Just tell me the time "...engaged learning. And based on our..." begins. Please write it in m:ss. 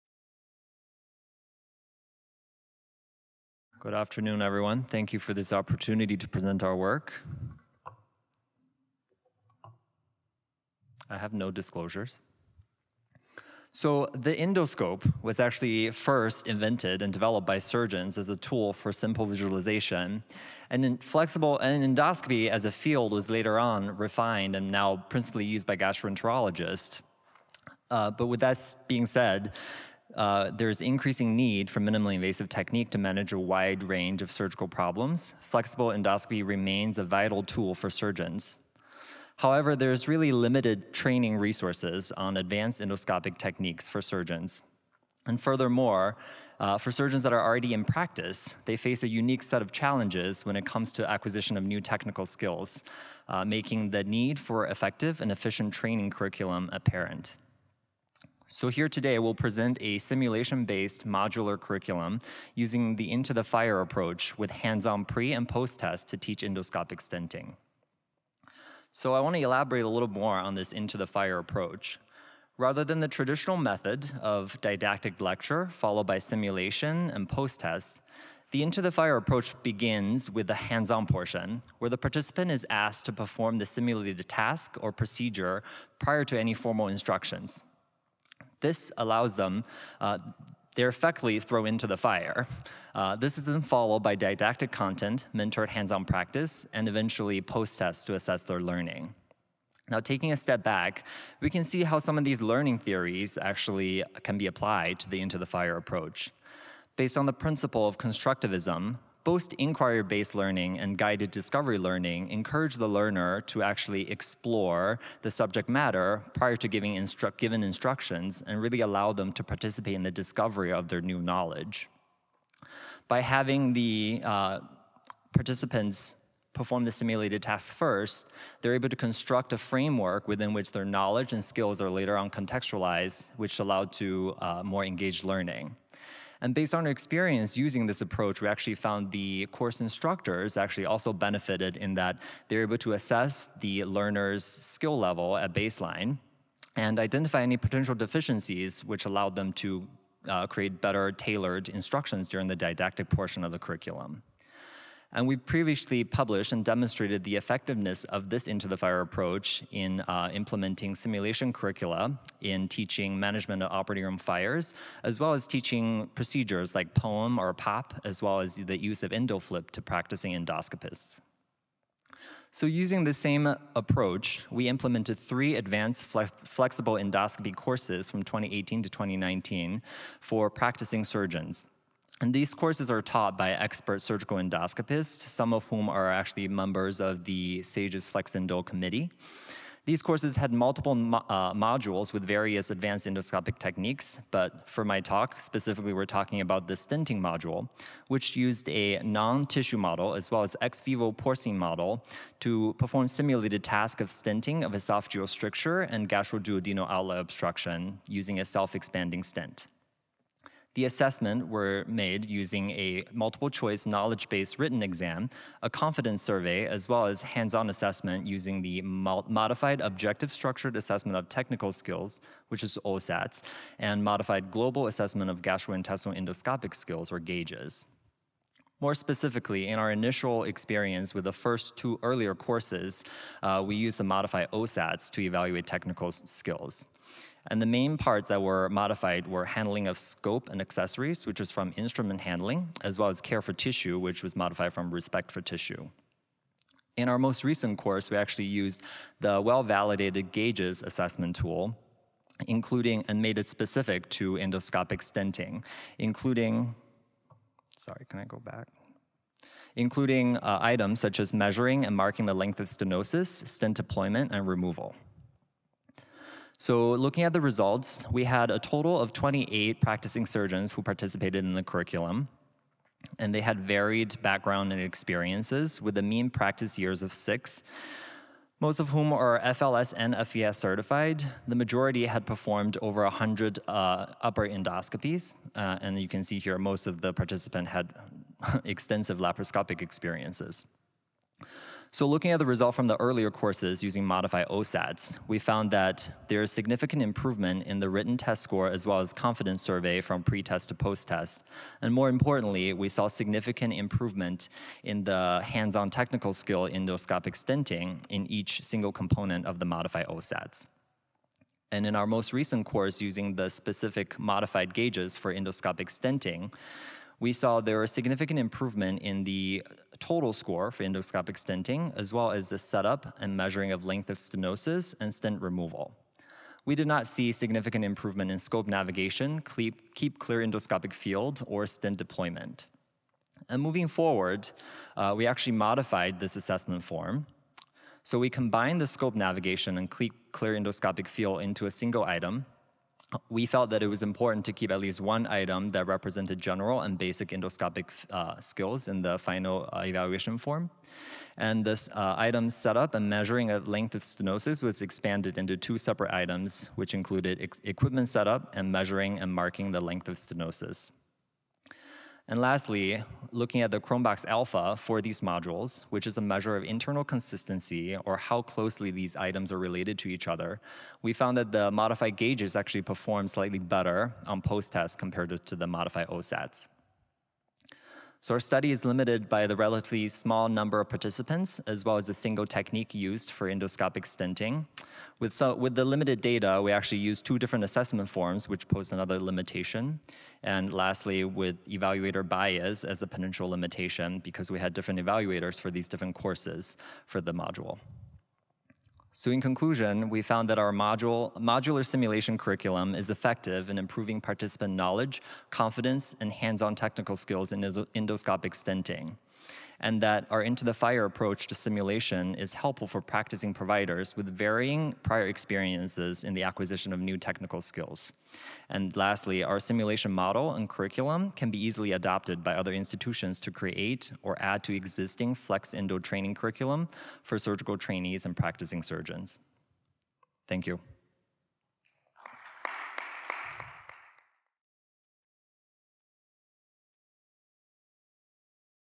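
2:14.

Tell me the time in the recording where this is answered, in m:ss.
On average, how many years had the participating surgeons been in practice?
4:37.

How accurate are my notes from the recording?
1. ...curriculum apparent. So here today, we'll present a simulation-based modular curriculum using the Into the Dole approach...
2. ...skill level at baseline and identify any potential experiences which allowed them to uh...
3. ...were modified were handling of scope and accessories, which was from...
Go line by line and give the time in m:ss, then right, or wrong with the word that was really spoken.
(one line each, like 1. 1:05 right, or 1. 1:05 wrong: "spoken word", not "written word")
1. 0:56 wrong: "Fire", not "Dole"
2. 2:24 wrong: "deficiencies", not "experiences"
3. 3:58 right.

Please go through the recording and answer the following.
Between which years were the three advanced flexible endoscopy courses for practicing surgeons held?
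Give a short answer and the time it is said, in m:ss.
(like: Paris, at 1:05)
2018 to 2019, at 2:58.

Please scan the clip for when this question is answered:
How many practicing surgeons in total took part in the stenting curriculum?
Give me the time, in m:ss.
4:29.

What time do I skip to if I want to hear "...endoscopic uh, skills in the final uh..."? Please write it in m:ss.
5:47.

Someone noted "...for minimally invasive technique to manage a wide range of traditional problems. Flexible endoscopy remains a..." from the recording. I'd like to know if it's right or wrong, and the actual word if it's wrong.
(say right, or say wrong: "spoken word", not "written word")
wrong: "surgical", not "traditional".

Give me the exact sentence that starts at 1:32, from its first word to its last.
Uh, this is then followed by didactic content, mentored hands-on practice, and eventually post-tests to assess their learning.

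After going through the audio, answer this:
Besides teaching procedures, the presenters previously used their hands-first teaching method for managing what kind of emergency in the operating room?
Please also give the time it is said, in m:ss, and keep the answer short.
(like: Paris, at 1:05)
Fires, at 2:43.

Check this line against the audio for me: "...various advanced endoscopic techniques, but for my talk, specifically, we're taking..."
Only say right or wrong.
wrong.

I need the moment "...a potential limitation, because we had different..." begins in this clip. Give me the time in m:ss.
6:33.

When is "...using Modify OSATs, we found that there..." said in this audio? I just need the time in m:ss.
4:53.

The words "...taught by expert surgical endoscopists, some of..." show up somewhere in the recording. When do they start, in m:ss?
3:03.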